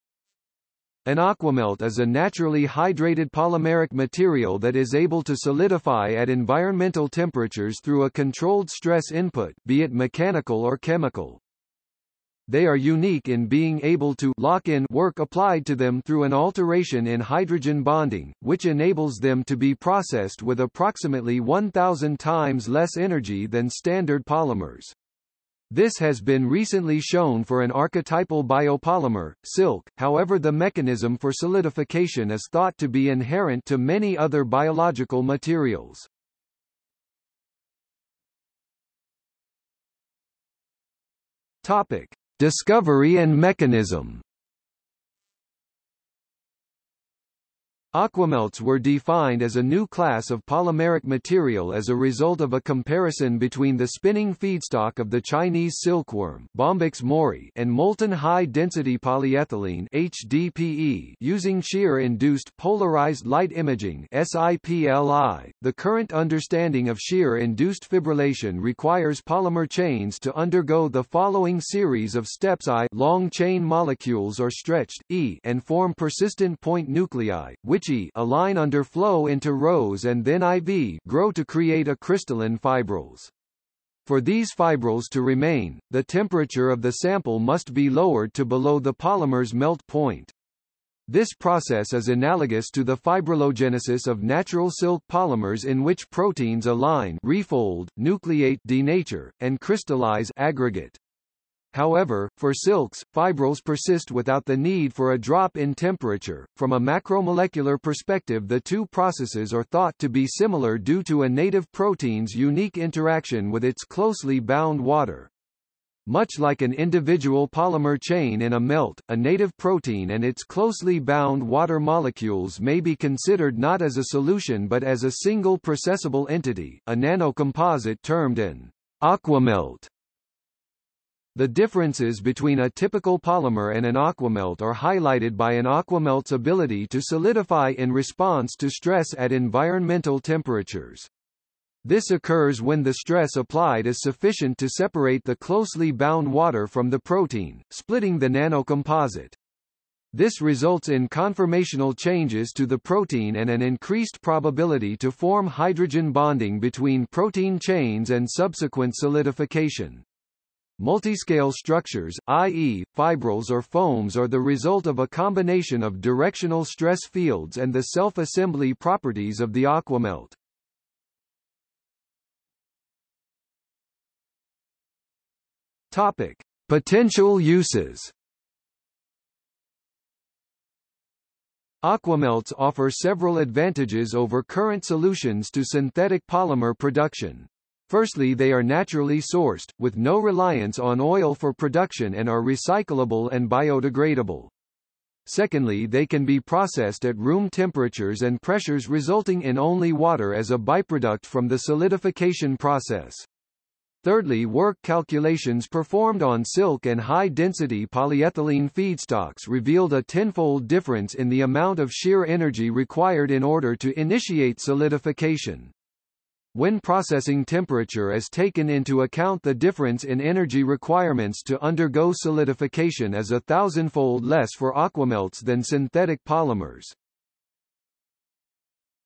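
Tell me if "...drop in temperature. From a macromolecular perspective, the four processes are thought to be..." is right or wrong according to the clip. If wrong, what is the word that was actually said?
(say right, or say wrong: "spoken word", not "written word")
wrong: "two", not "four".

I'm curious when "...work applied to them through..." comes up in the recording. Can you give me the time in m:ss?
0:14.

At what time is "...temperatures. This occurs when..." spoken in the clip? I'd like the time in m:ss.
2:20.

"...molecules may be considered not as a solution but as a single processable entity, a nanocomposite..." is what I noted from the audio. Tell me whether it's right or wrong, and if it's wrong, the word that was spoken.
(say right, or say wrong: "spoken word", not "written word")
right.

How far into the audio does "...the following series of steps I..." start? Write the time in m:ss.
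1:10.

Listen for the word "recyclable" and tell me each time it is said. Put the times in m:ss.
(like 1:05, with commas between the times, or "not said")
3:12.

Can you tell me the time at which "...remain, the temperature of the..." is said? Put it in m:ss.
1:25.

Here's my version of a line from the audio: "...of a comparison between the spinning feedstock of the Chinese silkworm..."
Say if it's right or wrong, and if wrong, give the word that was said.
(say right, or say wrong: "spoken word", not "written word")
right.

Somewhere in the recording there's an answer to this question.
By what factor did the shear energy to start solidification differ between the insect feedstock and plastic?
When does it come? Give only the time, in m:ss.
3:30.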